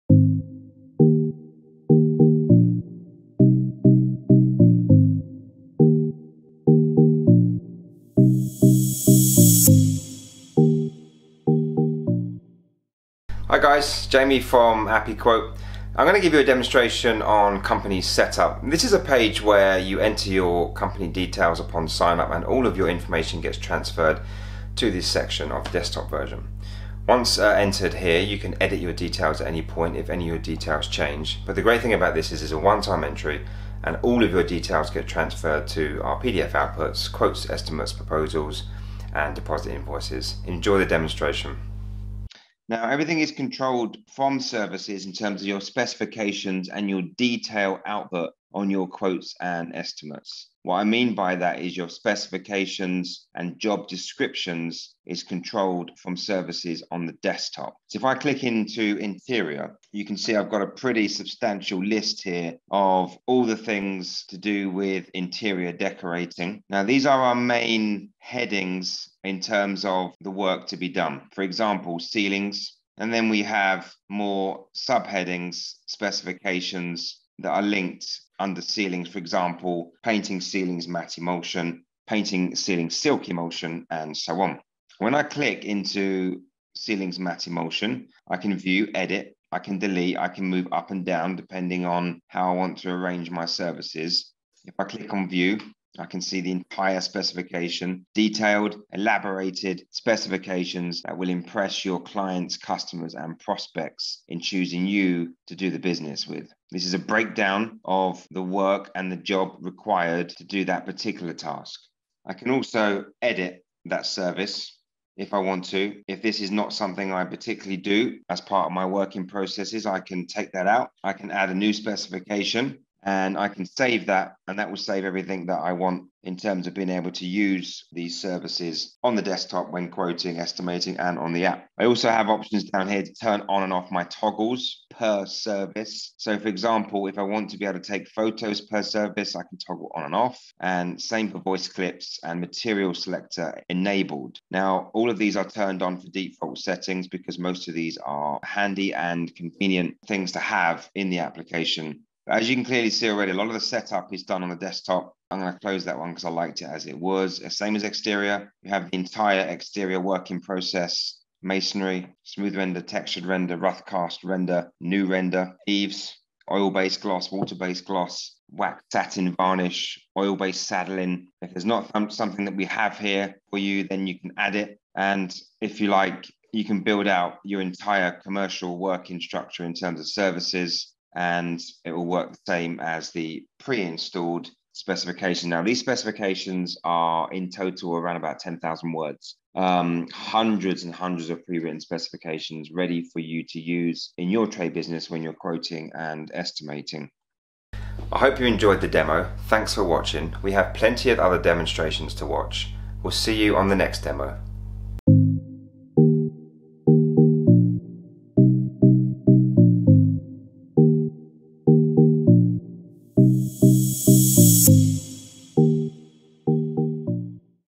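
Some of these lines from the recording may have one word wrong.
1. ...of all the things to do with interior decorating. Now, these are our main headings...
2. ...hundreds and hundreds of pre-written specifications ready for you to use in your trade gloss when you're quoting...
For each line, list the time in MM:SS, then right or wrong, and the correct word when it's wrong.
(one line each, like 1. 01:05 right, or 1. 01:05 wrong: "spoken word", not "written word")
1. 01:02 right
2. 03:10 wrong: "business", not "gloss".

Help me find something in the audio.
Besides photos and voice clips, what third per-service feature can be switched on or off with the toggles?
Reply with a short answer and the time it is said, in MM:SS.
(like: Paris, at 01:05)
material selector, at 02:22.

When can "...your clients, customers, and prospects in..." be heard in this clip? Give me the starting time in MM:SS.
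01:41.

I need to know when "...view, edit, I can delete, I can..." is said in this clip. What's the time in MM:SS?
01:28.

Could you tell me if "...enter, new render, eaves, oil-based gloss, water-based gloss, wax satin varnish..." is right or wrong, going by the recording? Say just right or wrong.
wrong.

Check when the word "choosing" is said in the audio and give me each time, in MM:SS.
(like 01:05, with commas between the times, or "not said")
01:44.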